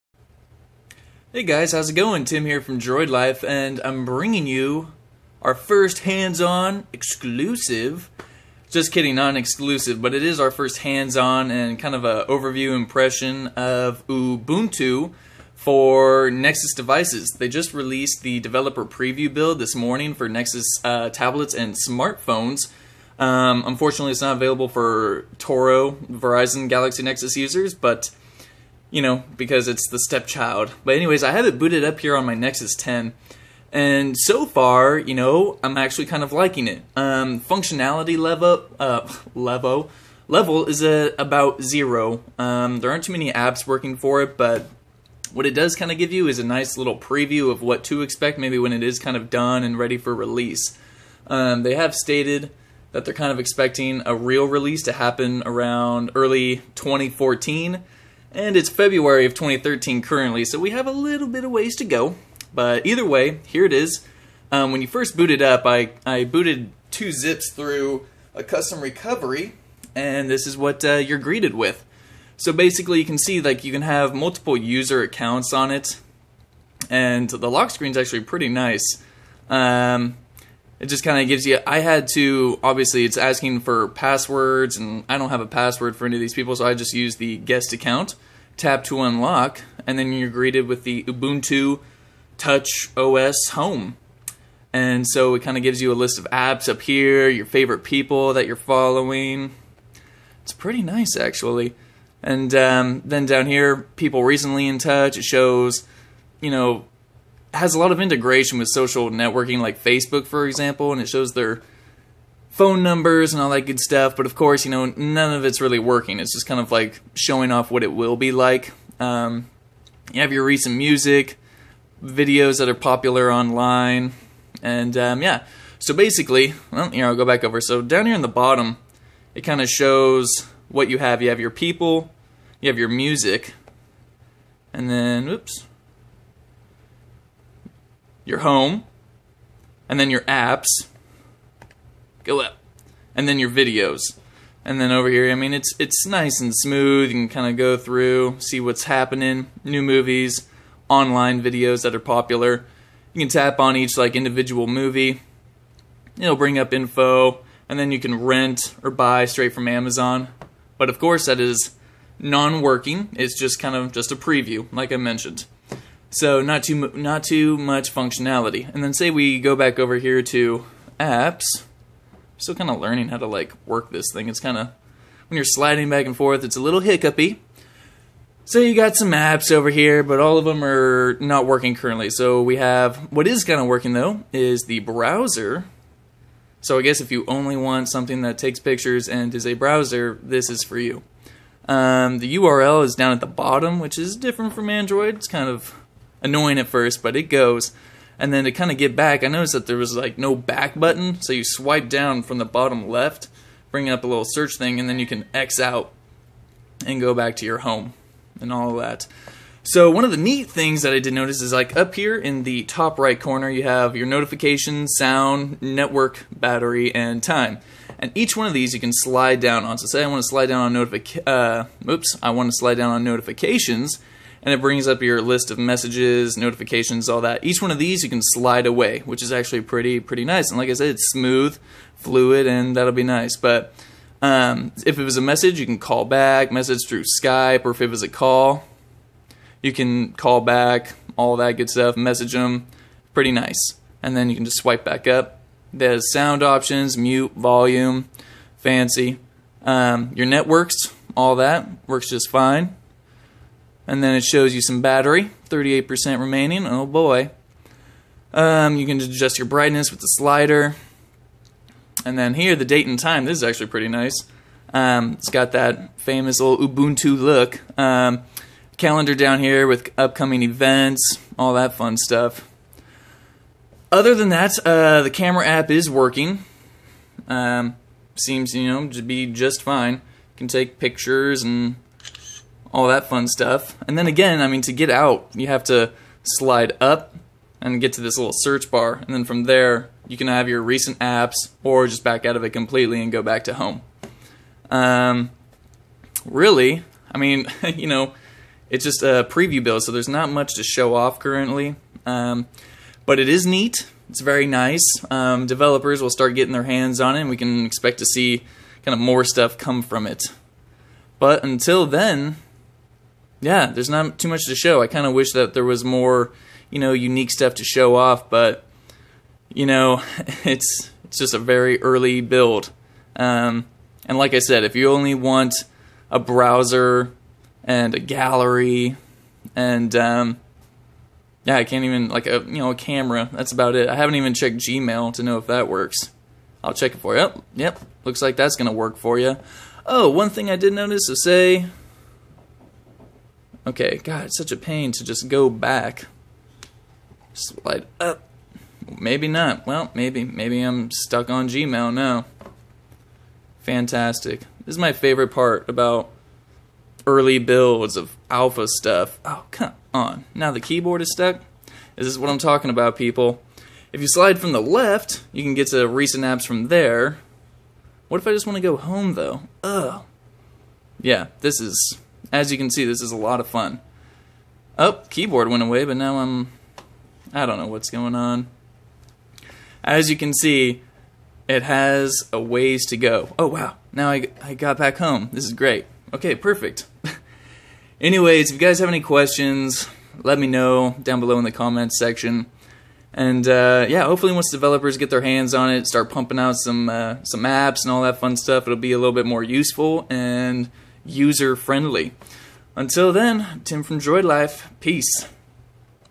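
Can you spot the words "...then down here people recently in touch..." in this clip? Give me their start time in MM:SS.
01:43.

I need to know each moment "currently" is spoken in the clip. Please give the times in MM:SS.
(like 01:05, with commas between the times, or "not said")
01:00, 03:01, 05:01.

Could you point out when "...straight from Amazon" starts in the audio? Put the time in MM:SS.
02:39.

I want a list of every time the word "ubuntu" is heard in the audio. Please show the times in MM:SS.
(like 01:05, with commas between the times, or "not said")
00:14, 01:31, 04:26.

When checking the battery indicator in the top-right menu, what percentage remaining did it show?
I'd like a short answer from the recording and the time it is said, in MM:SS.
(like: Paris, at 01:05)
38%, at 04:15.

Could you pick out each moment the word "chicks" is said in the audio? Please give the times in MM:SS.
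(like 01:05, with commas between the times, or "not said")
not said.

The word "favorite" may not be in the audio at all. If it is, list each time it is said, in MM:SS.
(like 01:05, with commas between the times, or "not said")
01:37, 05:54.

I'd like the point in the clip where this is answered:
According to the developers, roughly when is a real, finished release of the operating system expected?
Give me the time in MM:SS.
00:56.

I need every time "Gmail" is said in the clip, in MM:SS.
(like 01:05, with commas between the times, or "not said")
05:34, 05:51.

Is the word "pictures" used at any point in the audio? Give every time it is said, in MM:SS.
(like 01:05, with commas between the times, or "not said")
03:08, 04:40.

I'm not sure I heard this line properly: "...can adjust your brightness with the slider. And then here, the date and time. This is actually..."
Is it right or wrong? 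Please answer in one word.
right.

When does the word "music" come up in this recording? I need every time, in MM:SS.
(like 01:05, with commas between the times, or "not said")
02:00, 02:12.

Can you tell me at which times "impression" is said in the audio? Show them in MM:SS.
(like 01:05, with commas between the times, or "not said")
00:12.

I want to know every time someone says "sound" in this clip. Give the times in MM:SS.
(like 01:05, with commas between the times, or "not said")
03:34, 04:06.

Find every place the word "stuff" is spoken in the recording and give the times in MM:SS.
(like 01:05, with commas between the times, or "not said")
01:53, 04:01, 04:31, 04:43, 05:09, 05:17, 05:58, 06:38.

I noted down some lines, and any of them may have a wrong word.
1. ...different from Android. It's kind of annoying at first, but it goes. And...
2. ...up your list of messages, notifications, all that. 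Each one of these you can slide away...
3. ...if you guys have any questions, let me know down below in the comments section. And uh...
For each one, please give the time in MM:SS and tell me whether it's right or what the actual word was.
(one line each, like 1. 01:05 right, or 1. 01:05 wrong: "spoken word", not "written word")
1. 03:14 right
2. 03:44 right
3. 06:28 right.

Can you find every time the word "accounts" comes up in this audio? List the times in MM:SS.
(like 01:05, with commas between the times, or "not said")
01:15, 01:27.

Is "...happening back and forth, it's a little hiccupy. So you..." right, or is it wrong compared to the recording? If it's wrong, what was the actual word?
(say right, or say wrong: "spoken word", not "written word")
wrong: "sliding", not "happening".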